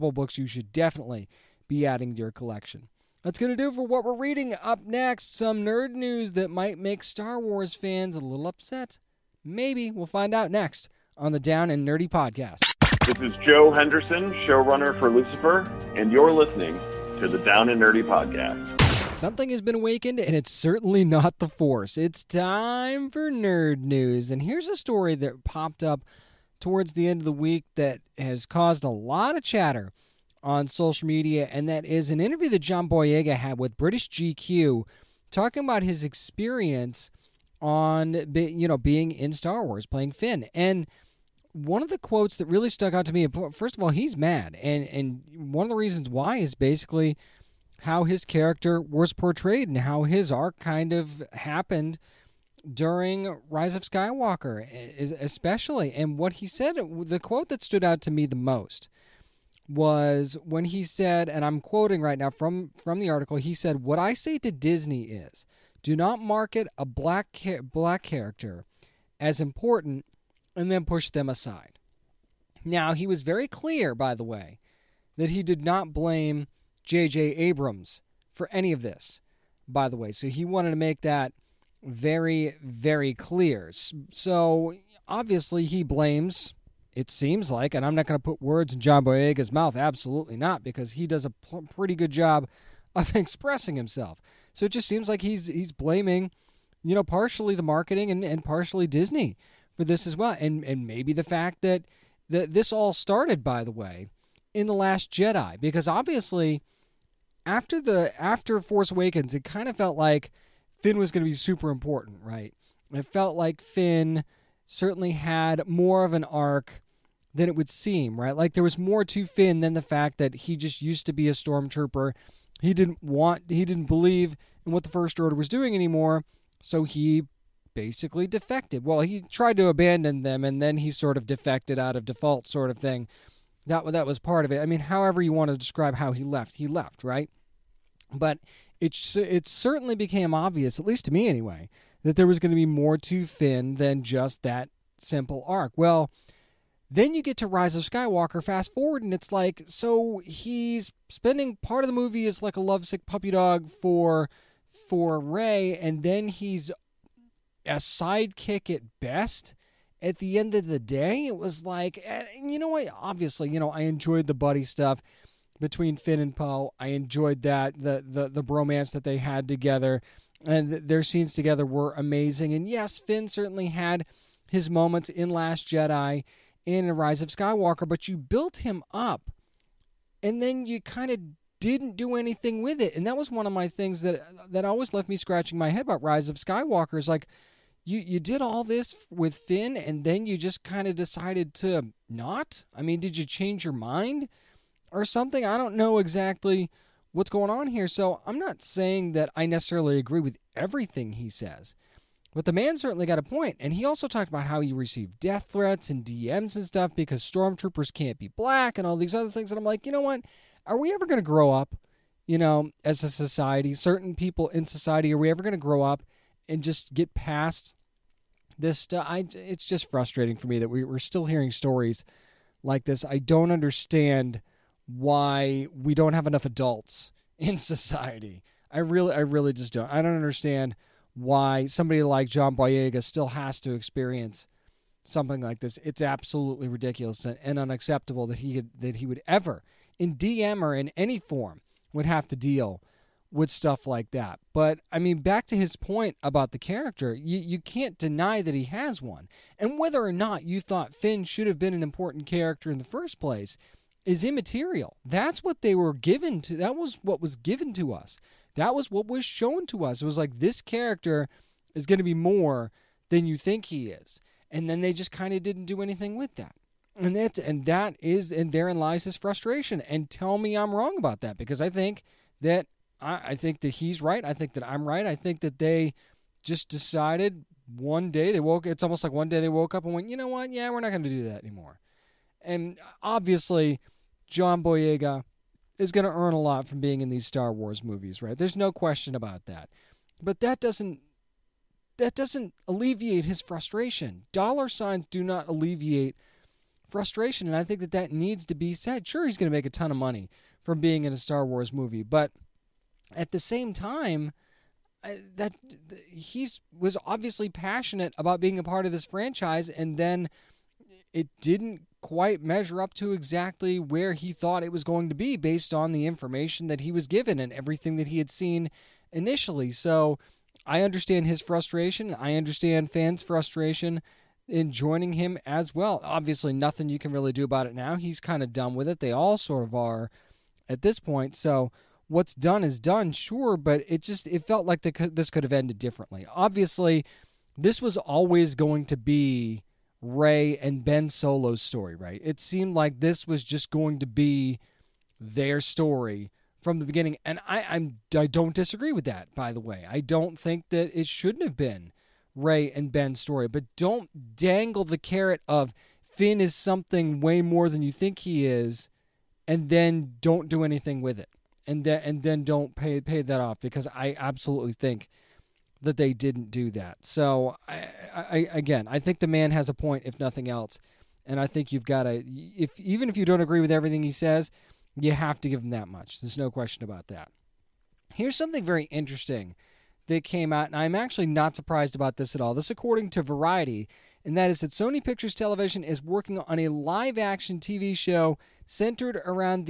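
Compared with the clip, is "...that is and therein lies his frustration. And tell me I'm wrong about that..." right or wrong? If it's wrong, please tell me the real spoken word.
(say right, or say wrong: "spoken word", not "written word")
right.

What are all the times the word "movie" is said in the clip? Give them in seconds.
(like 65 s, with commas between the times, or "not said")
151 s, 287 s, 301 s.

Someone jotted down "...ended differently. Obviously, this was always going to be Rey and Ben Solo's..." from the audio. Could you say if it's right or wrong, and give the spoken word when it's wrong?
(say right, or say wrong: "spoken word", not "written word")
right.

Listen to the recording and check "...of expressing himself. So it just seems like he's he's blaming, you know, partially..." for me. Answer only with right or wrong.
right.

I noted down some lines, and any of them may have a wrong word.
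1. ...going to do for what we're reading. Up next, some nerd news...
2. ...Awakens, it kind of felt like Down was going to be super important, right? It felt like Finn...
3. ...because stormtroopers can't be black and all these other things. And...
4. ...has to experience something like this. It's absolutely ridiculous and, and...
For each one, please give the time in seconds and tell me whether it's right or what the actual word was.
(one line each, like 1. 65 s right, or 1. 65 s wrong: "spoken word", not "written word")
1. 3 s right
2. 108 s wrong: "Finn", not "Down"
3. 206 s right
4. 233 s right.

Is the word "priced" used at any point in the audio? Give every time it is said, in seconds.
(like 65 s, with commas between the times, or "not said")
not said.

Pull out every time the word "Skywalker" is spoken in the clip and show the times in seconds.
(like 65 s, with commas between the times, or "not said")
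53 s, 147 s, 177 s, 186 s.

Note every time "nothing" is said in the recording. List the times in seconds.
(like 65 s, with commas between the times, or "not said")
326 s, 370 s.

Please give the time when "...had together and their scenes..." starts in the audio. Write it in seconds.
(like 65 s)
169 s.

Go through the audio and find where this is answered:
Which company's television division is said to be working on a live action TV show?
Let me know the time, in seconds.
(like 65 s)
384 s.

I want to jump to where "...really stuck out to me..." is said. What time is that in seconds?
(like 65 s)
42 s.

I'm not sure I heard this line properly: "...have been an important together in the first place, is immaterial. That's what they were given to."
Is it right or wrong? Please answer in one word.
wrong.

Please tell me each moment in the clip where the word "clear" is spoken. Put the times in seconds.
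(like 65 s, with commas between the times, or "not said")
73 s, 83 s.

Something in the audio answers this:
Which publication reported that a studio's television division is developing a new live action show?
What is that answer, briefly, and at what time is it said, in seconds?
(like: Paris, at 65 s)
Variety, at 383 s.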